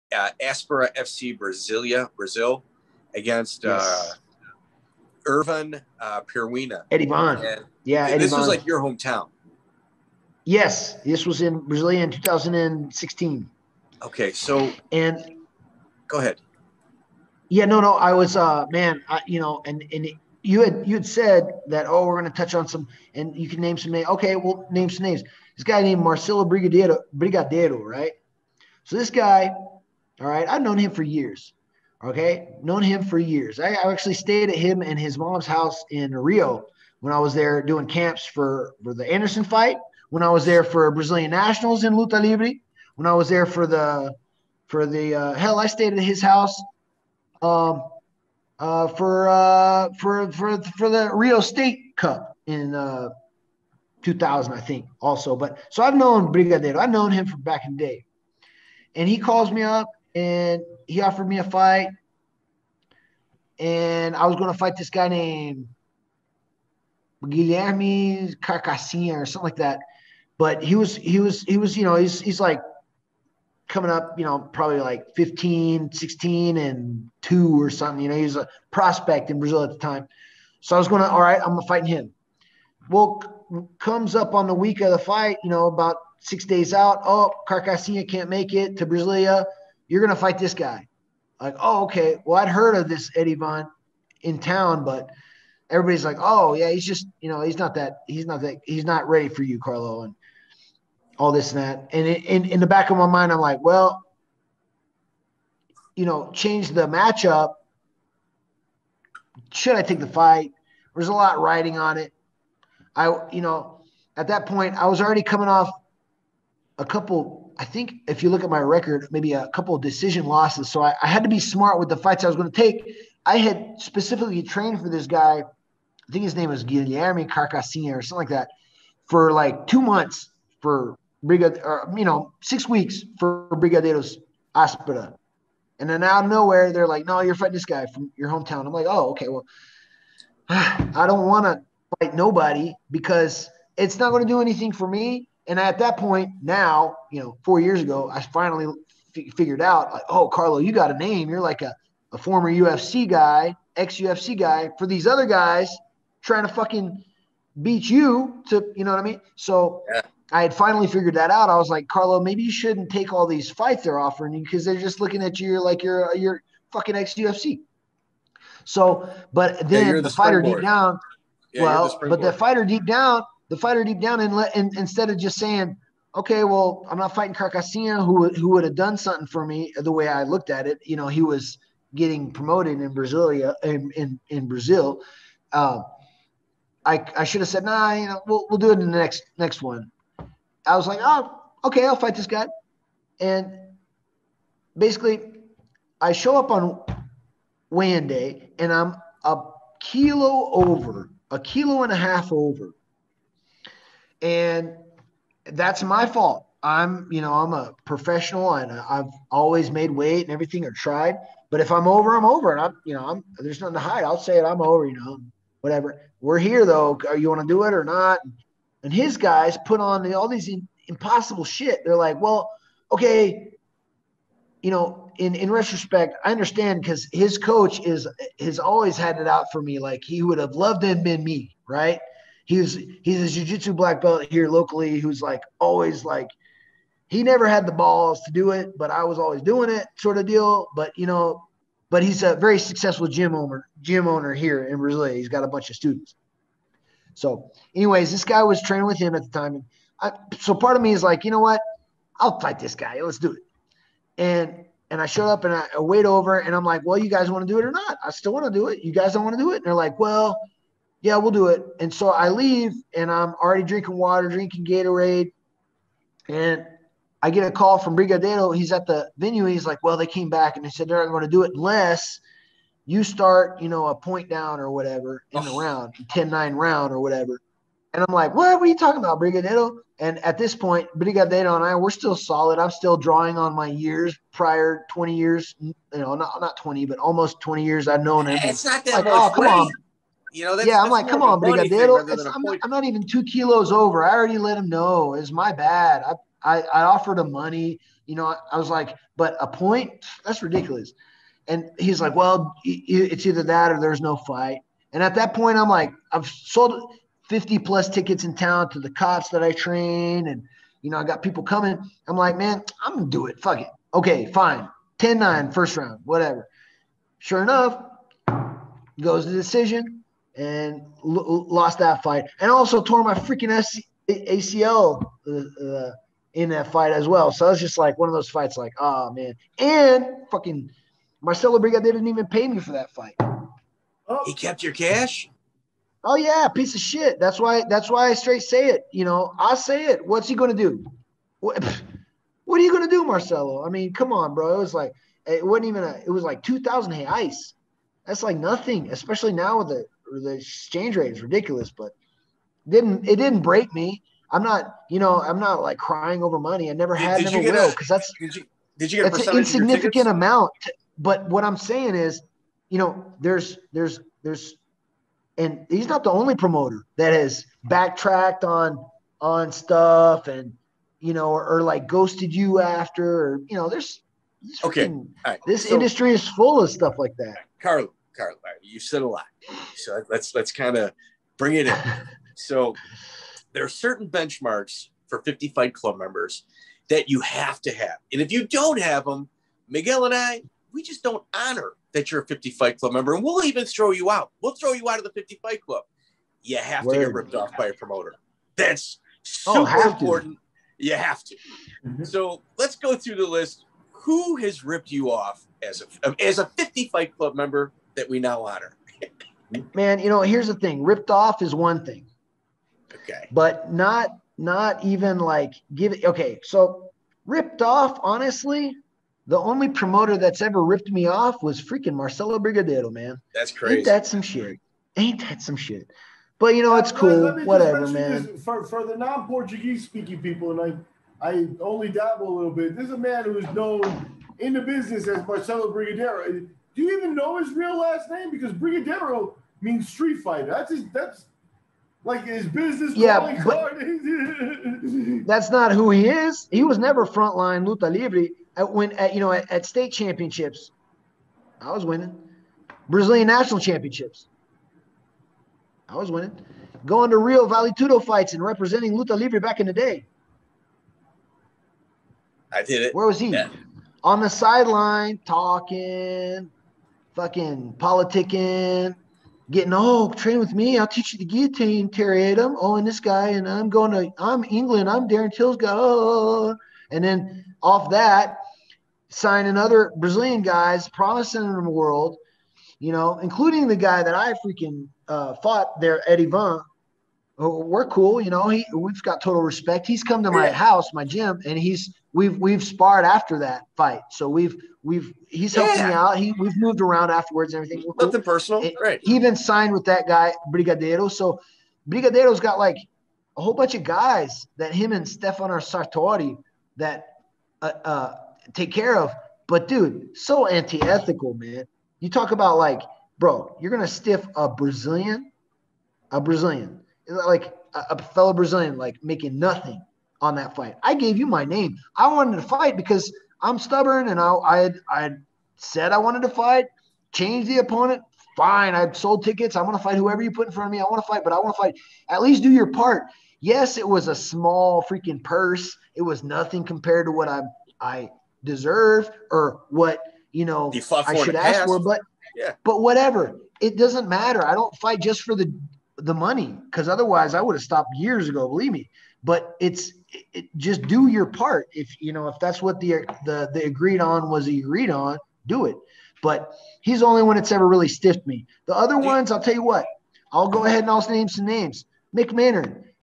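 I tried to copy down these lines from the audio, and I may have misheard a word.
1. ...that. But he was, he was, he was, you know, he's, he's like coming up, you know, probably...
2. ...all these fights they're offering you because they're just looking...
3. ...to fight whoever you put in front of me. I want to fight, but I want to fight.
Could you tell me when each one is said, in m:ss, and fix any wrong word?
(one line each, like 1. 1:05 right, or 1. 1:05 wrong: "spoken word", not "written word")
1. 1:09 right
2. 2:43 right
3. 8:49 right.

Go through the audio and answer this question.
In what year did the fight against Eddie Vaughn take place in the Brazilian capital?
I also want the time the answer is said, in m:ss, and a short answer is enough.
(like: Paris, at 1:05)
2016, at 0:12.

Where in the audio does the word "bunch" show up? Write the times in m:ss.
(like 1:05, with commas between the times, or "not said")
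4:05, 8:23.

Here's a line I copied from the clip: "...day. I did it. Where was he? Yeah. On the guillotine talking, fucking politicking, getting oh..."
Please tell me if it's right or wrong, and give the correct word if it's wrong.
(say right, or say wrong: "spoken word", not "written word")
wrong: "sideline", not "guillotine".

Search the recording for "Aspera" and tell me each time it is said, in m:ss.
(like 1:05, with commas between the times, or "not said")
0:00, 2:14.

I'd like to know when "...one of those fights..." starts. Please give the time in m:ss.
5:27.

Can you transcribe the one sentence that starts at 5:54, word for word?
I'm not, you know, I'm not like crying over money.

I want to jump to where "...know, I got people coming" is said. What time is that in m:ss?
5:10.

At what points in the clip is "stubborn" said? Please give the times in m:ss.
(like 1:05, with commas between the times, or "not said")
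8:43.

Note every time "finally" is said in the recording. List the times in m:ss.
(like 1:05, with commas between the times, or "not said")
2:28, 2:40.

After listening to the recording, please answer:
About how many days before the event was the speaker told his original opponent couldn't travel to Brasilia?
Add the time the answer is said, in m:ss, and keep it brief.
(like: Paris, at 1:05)
6, at 1:26.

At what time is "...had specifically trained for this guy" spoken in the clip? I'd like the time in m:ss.
2:03.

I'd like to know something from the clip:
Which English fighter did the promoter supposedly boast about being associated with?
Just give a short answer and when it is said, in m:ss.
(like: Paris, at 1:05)
Darren Till, at 7:55.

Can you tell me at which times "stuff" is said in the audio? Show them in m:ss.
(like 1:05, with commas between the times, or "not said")
6:09, 6:16.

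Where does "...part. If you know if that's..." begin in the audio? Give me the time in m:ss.
9:11.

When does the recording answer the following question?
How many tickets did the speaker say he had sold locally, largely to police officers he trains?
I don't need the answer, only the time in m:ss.
5:07.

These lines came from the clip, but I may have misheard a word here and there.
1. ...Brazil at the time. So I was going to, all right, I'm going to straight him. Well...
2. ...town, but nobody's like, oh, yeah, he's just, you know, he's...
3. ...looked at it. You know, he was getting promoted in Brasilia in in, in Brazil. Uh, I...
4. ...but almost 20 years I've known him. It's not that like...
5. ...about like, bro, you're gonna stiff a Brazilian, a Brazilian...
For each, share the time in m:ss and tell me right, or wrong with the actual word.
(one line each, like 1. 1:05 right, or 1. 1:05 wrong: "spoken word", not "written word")
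1. 1:19 wrong: "fight", not "straight"
2. 1:34 wrong: "everybody", not "nobody"
3. 3:00 right
4. 4:46 right
5. 8:32 right.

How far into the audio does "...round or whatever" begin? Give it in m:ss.
4:36.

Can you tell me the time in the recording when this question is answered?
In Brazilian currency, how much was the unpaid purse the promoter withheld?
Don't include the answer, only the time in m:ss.
5:46.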